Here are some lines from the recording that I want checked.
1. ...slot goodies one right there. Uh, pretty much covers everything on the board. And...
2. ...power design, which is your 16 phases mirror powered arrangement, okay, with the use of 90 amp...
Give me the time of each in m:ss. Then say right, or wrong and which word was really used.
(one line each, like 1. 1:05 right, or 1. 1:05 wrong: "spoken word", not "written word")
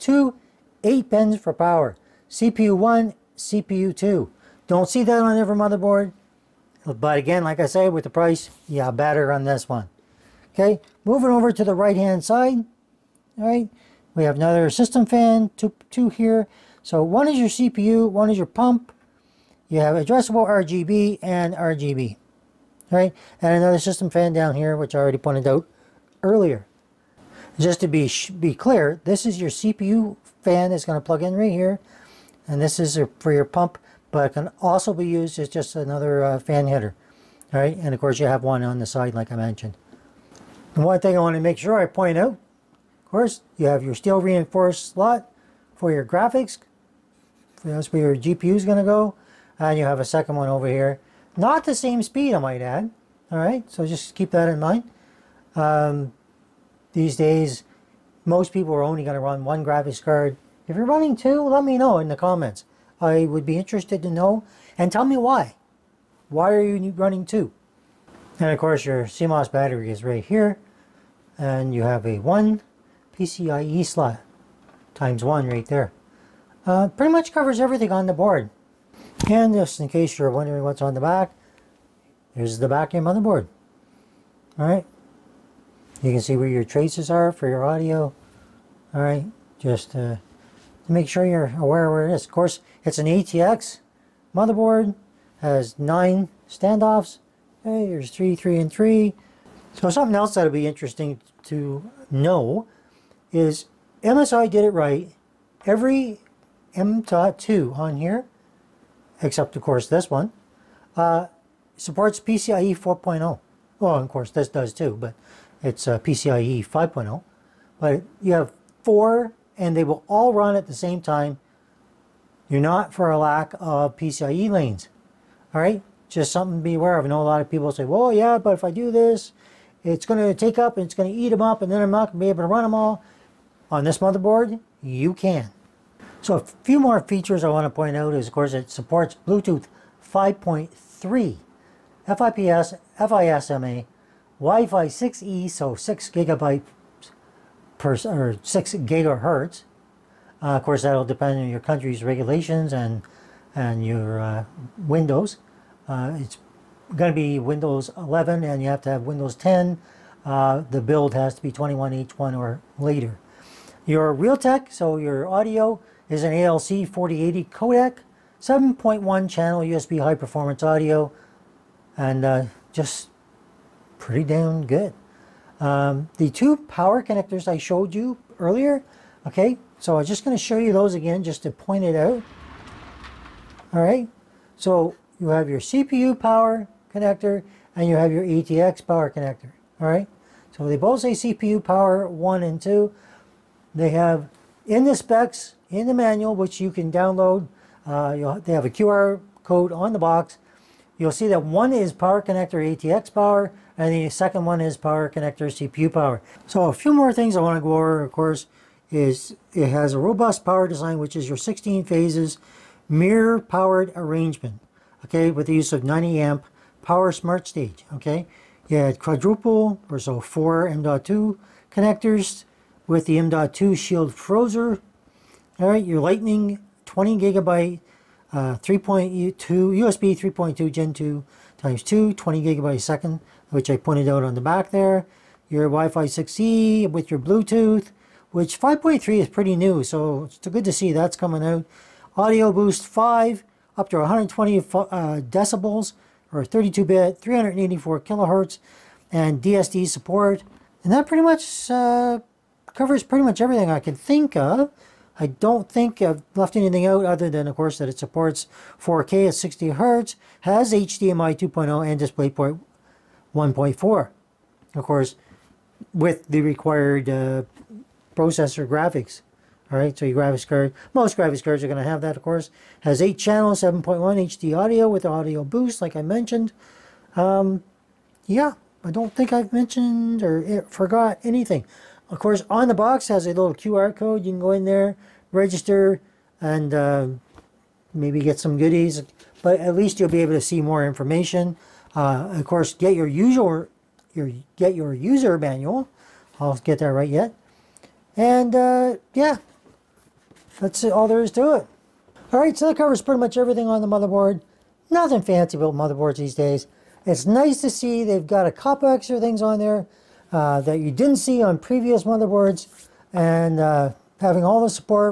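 1. 1:13 wrong: "times", not "goodies"
2. 3:30 right.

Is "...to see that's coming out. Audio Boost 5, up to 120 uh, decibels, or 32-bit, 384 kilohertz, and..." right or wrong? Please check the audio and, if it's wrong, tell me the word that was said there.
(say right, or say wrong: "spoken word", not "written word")
right.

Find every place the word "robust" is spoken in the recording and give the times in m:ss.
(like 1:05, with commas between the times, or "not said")
3:29.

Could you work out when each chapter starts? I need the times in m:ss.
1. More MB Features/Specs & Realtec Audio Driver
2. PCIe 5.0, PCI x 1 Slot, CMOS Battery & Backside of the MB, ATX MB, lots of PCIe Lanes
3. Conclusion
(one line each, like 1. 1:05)
1. 2:16
2. 0:40
3. 5:02.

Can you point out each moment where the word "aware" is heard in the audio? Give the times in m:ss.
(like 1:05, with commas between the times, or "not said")
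1:31, 2:06.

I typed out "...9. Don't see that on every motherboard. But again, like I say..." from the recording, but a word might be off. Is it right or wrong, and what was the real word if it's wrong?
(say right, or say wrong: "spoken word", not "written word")
wrong: "2", not "9".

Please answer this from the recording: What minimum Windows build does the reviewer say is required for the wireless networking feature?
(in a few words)
21H1.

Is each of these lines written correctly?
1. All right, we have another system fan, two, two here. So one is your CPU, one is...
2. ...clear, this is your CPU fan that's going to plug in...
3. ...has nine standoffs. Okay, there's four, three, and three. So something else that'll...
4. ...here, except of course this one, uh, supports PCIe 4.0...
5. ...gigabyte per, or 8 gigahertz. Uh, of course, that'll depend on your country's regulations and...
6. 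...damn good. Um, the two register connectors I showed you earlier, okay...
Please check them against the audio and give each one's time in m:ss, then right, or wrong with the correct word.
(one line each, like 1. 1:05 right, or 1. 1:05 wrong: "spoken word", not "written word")
1. 0:13 right
2. 0:28 right
3. 1:35 wrong: "three", not "four"
4. 1:47 right
5. 2:26 wrong: "6", not "8"
6. 2:54 wrong: "power", not "register".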